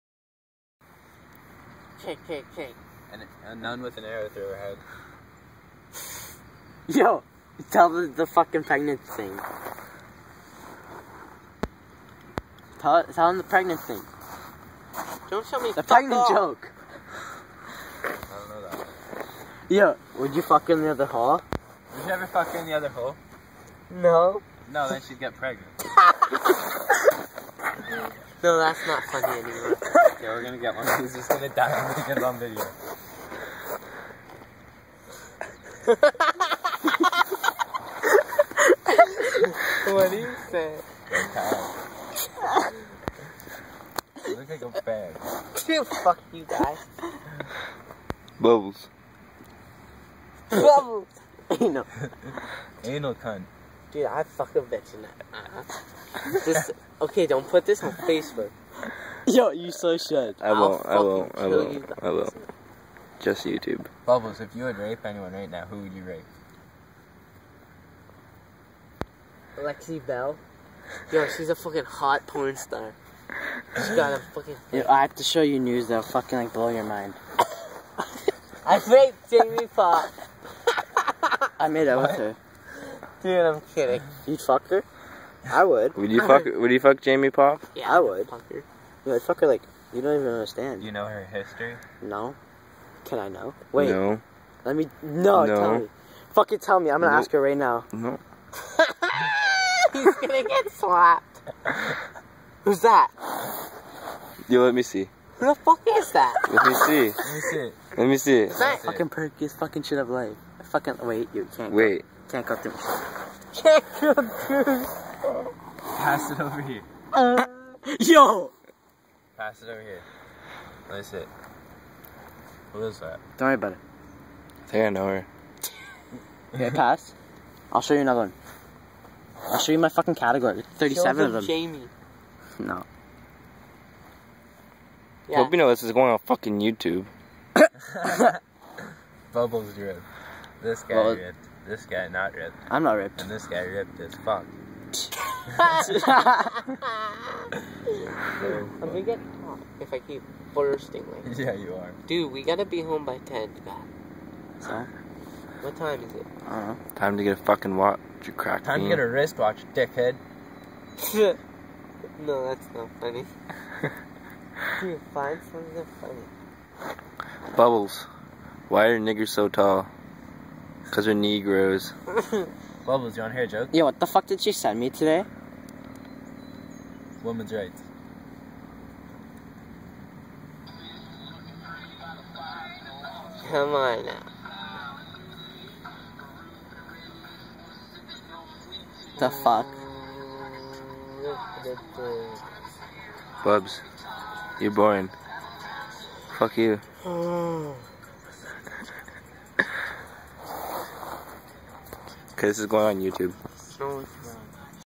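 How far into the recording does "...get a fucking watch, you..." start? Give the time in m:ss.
2:37.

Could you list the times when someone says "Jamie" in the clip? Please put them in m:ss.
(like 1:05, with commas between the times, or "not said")
1:19, 1:27, 2:11.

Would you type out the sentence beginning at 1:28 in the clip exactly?
Fuck her you like, fucker, like, you don't even understand.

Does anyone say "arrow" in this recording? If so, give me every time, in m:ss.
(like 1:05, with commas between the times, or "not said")
0:04.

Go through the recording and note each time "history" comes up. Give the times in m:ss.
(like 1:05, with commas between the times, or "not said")
1:31.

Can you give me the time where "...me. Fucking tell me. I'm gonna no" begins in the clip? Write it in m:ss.
1:35.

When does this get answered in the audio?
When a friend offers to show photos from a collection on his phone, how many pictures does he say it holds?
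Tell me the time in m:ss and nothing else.
2:10.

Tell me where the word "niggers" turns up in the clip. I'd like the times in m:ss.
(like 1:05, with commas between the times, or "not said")
2:48.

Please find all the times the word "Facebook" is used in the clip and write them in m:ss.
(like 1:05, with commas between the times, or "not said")
0:57.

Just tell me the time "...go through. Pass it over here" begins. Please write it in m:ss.
1:53.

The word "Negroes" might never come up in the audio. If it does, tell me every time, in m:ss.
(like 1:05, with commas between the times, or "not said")
2:51.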